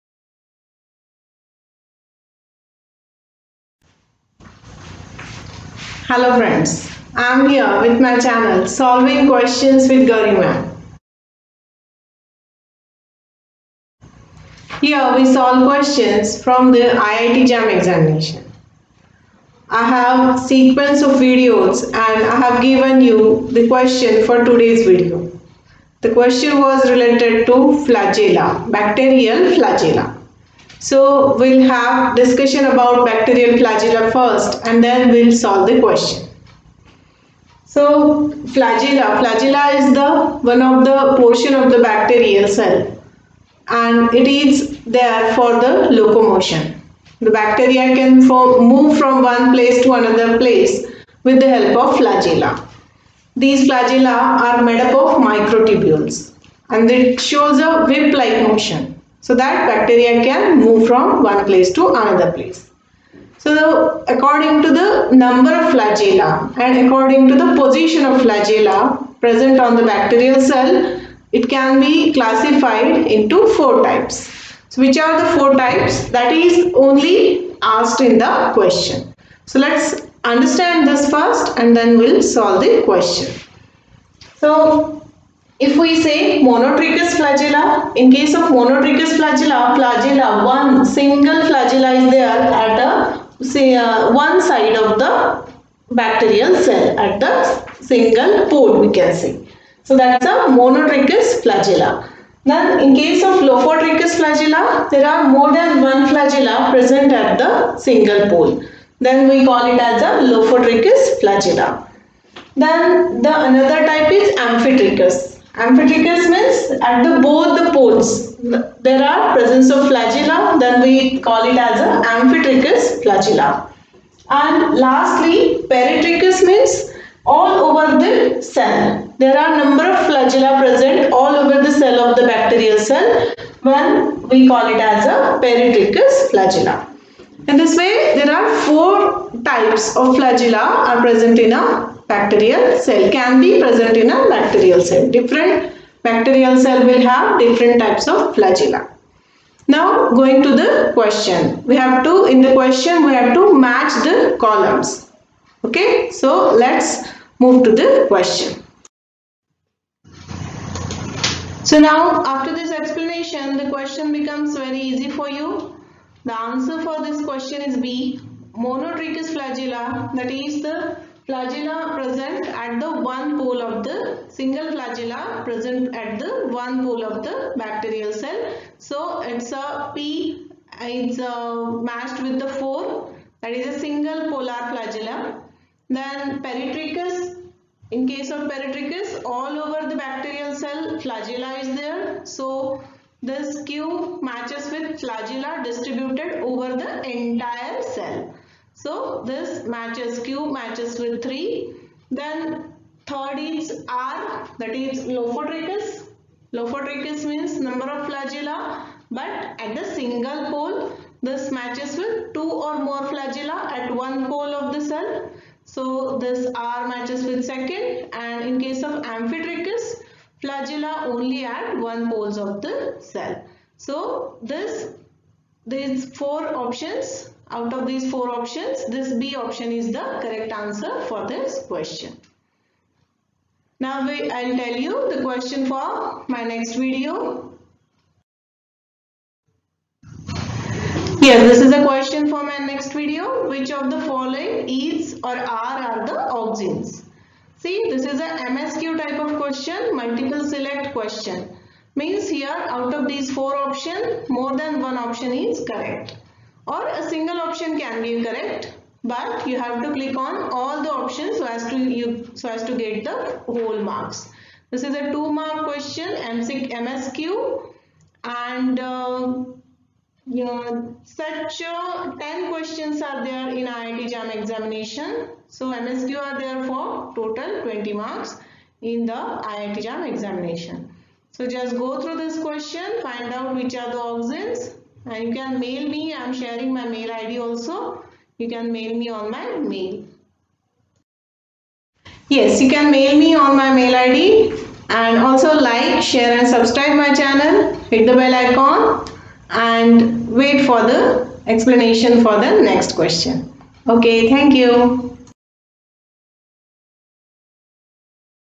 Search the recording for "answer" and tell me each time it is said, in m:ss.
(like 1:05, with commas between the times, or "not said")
2:46, 3:50.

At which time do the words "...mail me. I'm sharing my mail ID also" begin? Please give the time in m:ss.
4:45.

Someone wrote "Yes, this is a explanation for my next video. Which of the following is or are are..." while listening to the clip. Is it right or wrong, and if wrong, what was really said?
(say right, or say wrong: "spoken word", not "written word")
wrong: "question", not "explanation".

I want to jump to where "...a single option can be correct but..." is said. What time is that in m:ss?
4:16.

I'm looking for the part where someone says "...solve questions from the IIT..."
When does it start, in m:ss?
0:15.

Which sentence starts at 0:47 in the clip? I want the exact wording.
The bacteria can form, move from one place to another place with the help of flagella.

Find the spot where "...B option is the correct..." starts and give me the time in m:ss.
3:49.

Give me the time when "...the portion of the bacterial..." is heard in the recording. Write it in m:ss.
0:40.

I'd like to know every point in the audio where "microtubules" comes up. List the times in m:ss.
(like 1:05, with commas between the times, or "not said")
0:55.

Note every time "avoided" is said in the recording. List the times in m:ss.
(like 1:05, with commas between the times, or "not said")
not said.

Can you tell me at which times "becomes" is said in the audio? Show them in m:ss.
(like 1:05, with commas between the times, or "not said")
2:44.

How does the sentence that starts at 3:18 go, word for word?
So this matches Q matches with 3.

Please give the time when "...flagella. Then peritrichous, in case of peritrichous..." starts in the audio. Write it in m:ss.
3:04.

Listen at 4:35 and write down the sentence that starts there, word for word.
So MSQ are there for total 20 marks in the IIT JAM examination.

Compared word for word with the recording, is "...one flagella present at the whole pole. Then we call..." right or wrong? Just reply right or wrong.
wrong.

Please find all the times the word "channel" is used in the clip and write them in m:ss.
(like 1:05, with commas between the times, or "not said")
0:08, 4:57.